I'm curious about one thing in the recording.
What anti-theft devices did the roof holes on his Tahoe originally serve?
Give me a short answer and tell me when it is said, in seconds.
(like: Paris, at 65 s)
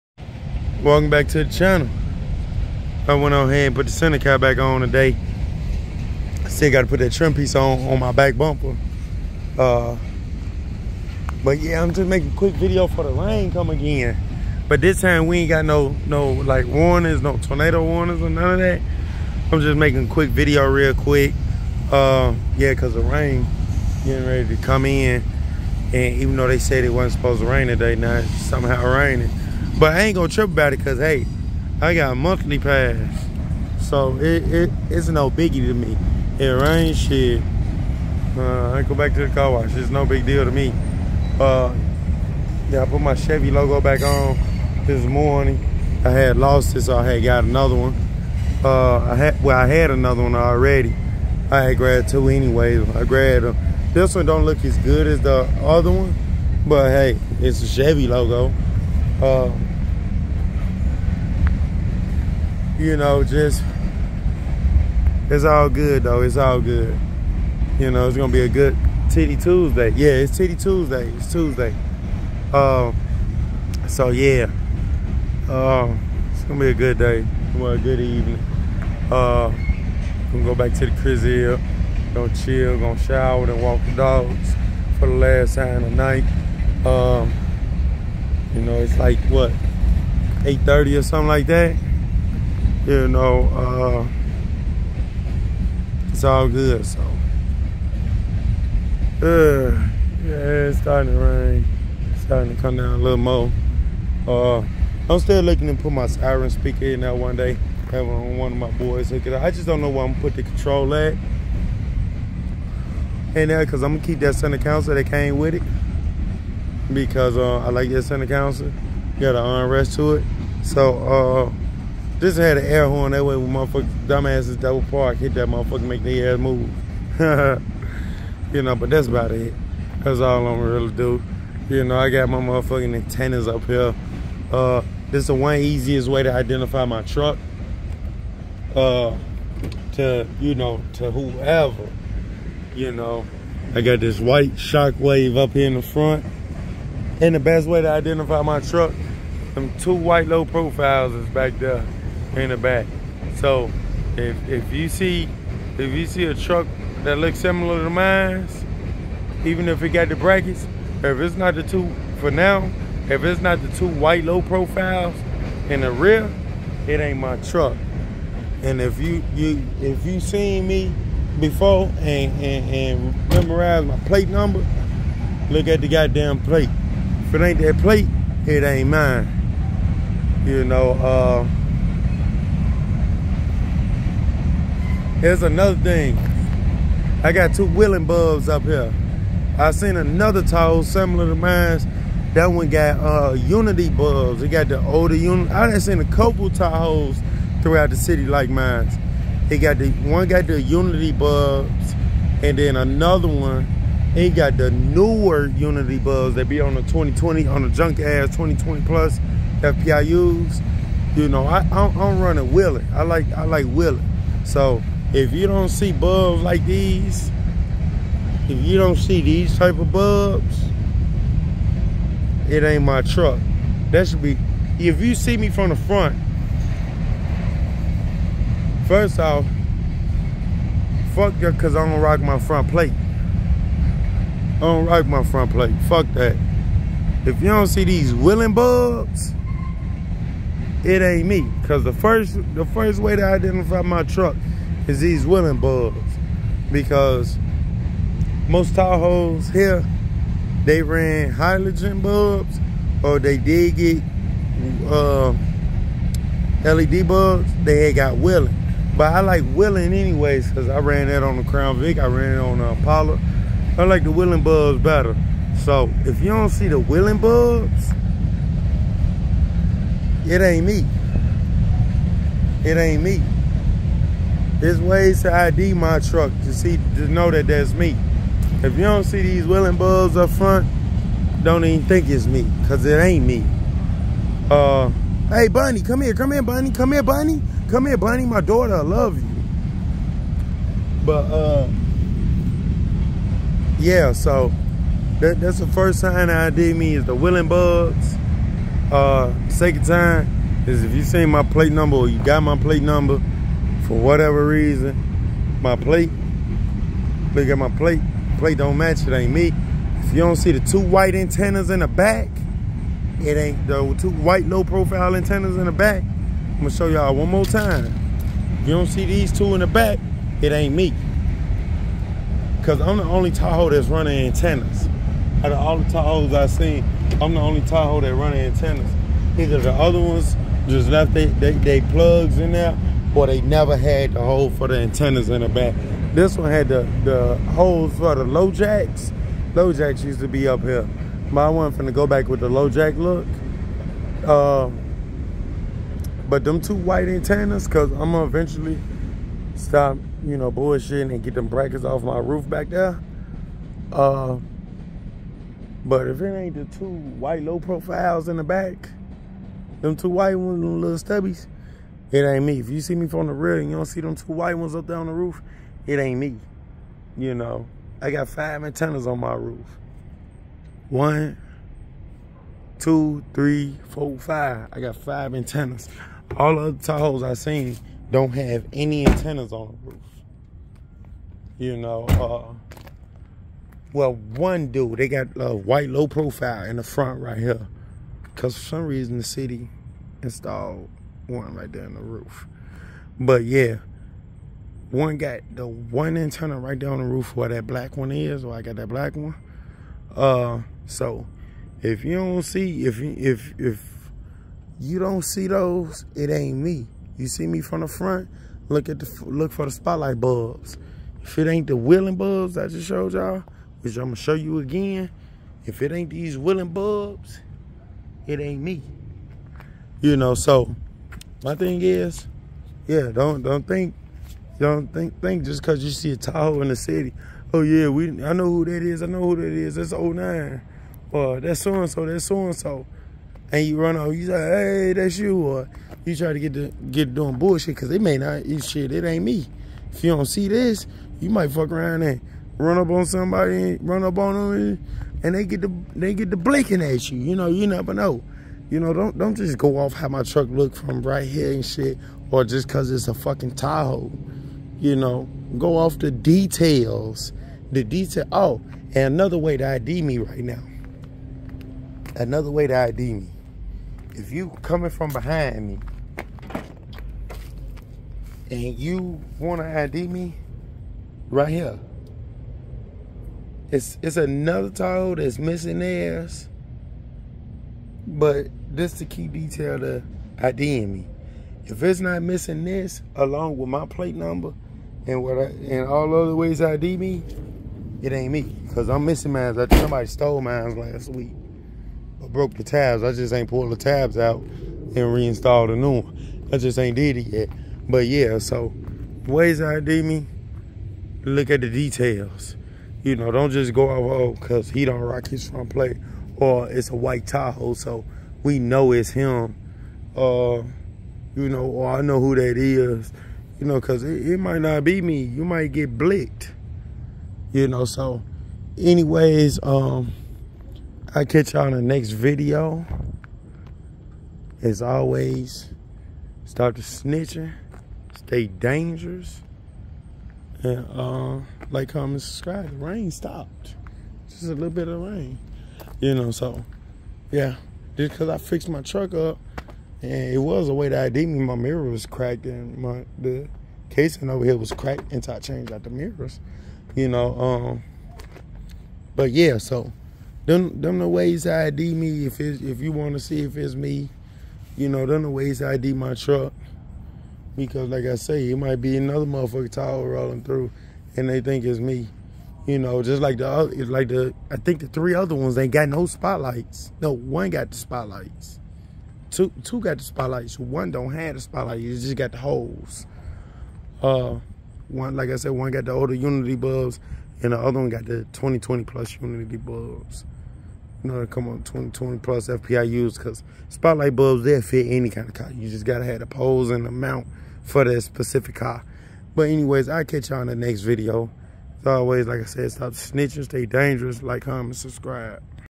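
LoJacks, at 338 s.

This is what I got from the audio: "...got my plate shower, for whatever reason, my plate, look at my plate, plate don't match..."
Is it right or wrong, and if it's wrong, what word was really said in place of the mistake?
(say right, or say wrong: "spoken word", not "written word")
wrong: "number", not "shower".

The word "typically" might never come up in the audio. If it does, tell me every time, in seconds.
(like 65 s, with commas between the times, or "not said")
not said.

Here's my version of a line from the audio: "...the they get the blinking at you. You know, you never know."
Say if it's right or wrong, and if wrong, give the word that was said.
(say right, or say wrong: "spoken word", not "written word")
right.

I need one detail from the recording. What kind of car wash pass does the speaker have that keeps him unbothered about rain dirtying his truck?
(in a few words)
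Monthly pass.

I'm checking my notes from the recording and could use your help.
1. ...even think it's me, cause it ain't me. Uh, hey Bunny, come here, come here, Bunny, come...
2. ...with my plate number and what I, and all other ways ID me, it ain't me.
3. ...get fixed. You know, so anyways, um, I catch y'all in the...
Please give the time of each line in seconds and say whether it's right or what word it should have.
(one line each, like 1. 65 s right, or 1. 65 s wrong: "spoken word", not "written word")
1. 281 s right
2. 483 s right
3. 515 s wrong: "blicked", not "fixed".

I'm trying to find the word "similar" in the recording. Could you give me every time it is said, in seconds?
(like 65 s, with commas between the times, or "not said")
157 s, 190 s.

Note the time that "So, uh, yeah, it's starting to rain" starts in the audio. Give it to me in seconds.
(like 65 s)
96 s.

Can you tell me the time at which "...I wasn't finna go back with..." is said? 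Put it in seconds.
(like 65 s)
341 s.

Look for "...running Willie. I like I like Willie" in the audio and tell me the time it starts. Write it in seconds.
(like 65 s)
212 s.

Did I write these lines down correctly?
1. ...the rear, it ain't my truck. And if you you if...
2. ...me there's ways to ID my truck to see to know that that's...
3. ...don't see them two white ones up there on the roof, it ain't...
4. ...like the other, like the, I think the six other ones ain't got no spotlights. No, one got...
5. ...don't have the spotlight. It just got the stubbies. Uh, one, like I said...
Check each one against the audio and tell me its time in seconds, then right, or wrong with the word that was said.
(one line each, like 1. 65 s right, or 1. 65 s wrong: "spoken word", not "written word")
1. 165 s right
2. 273 s right
3. 363 s right
4. 563 s wrong: "three", not "six"
5. 570 s wrong: "holes", not "stubbies".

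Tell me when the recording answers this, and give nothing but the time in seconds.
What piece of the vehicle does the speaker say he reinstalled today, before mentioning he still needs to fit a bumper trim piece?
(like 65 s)
3 s.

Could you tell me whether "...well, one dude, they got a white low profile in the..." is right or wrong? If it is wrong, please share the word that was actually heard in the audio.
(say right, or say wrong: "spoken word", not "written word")
right.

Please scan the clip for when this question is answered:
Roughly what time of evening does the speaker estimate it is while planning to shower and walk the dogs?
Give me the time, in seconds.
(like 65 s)
90 s.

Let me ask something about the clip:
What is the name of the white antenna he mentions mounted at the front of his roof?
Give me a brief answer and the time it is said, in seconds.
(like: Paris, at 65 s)
Shockwave, at 144 s.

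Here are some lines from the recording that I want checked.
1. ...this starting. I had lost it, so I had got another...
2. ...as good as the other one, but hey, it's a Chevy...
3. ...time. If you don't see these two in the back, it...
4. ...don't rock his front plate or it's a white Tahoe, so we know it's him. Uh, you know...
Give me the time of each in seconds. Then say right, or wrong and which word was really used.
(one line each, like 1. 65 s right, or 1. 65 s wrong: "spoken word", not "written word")
1. 44 s wrong: "morning", not "starting"
2. 54 s right
3. 317 s right
4. 504 s right.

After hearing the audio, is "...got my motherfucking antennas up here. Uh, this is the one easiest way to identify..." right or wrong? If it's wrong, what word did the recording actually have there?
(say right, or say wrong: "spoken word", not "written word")
right.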